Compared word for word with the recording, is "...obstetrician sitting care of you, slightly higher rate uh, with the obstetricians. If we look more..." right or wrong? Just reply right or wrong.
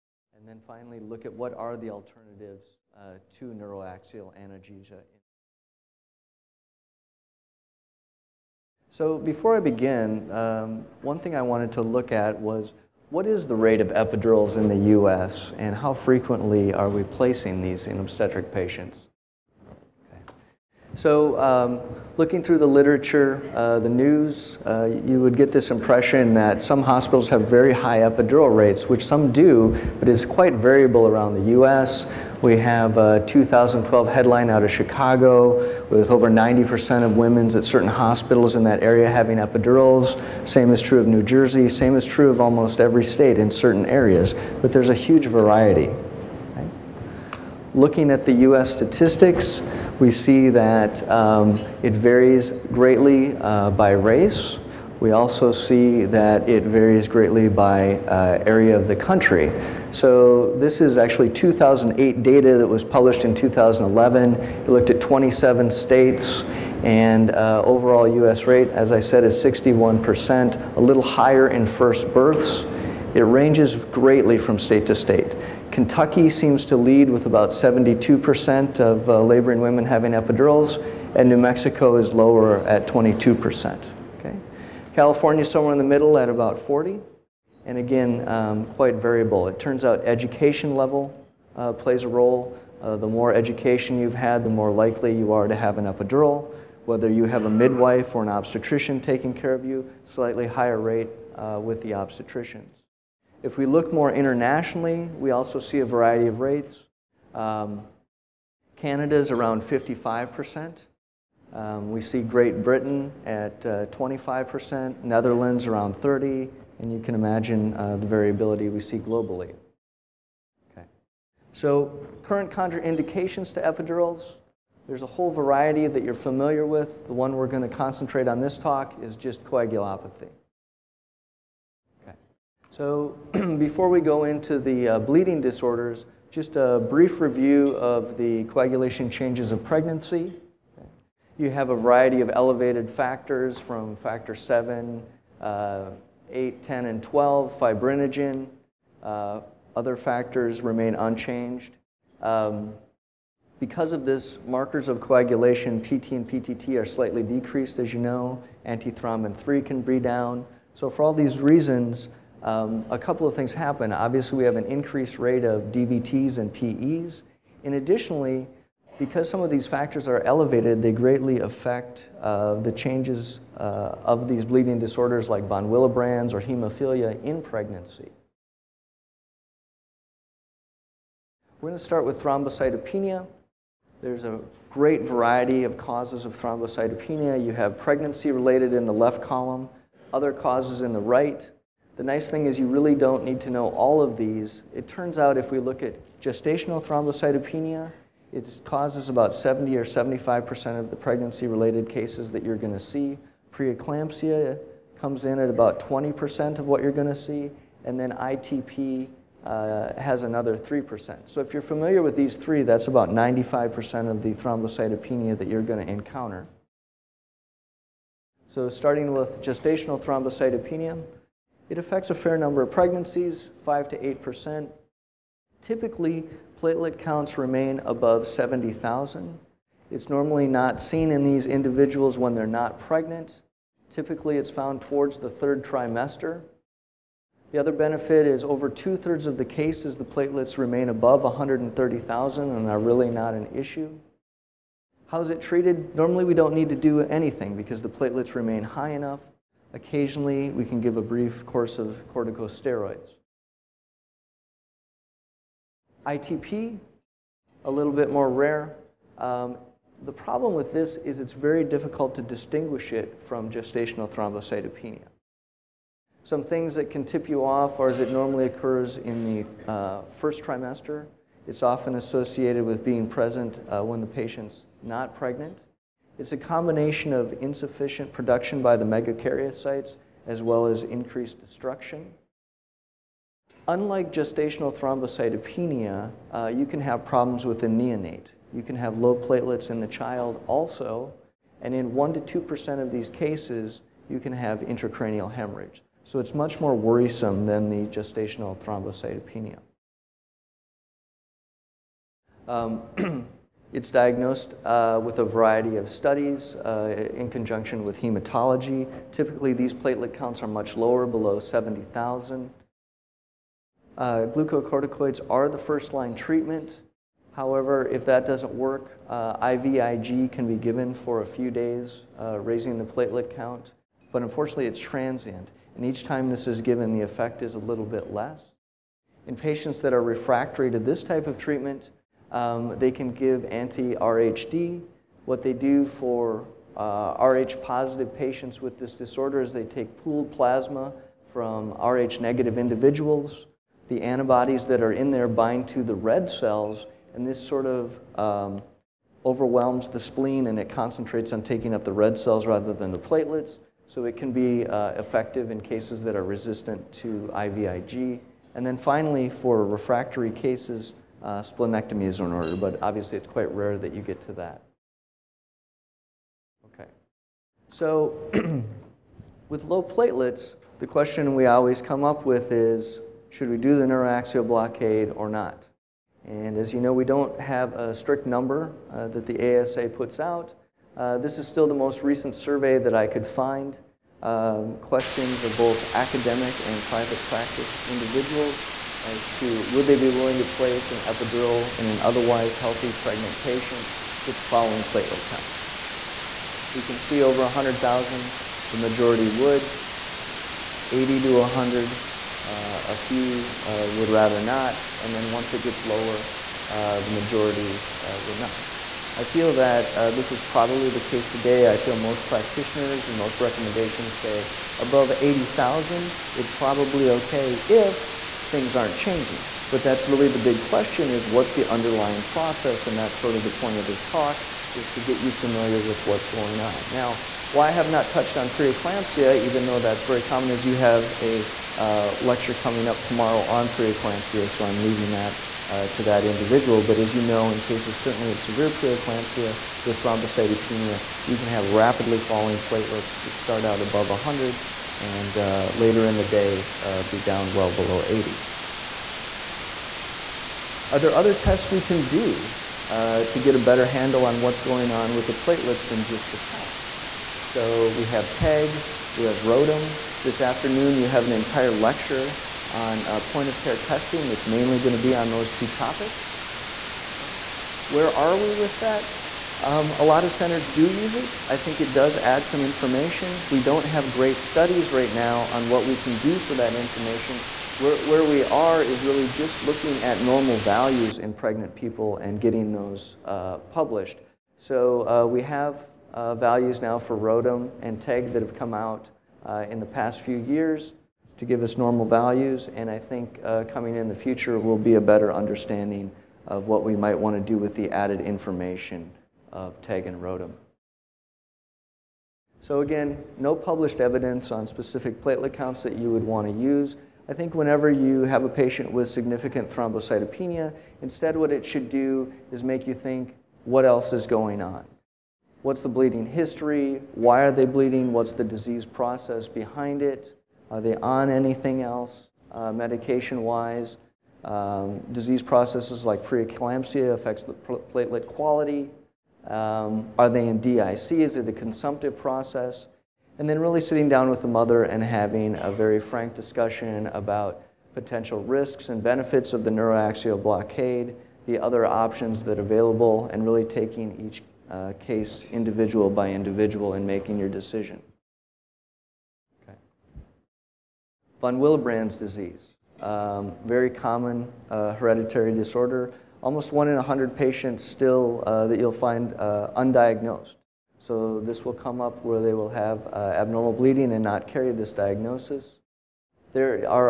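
wrong.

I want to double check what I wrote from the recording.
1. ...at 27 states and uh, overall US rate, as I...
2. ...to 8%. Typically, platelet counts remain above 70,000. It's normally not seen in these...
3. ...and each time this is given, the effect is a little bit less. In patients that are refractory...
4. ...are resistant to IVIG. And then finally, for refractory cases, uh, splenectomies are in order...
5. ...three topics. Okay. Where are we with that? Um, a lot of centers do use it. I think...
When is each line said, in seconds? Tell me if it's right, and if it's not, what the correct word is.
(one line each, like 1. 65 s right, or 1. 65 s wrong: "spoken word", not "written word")
1. 64 s right
2. 223 s right
3. 325 s right
4. 356 s right
5. 465 s wrong: "two", not "three".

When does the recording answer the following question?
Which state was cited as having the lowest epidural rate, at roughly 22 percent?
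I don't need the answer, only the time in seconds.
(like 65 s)
81 s.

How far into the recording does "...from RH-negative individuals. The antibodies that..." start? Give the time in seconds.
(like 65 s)
341 s.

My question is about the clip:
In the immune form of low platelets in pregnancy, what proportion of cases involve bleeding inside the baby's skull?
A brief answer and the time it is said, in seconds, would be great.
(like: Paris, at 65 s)
1% to 2%, at 291 s.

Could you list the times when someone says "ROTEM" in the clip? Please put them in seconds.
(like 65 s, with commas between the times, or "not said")
459 s, 487 s, 500 s.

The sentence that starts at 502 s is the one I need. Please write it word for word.
So again, no published evidence on specific platelet counts that you would want to use.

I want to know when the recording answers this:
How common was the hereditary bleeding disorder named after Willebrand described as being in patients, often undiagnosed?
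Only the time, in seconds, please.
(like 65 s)
556 s.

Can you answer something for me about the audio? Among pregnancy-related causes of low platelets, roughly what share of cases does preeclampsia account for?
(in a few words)
20%.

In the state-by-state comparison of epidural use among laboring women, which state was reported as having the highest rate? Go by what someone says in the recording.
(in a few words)
Kentucky.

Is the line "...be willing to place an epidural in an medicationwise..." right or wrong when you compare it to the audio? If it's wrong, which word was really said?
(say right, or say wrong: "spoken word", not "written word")
wrong: "otherwise", not "medicationwise".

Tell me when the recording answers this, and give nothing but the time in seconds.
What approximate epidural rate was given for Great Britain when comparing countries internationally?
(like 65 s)
113 s.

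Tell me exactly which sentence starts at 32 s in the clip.
We have a uh, 2012 headline out of Chicago with over 90% of women's at certain hospitals in that area having epidurals.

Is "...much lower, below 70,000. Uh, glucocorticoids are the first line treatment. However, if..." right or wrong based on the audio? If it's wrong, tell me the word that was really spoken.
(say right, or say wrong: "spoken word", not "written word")
right.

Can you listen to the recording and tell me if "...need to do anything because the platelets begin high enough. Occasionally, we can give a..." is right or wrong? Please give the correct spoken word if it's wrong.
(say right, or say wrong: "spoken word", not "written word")
wrong: "remain", not "begin".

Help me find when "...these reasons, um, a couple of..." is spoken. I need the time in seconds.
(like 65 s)
161 s.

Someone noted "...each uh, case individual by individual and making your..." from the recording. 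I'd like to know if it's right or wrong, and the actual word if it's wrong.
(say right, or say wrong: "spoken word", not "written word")
right.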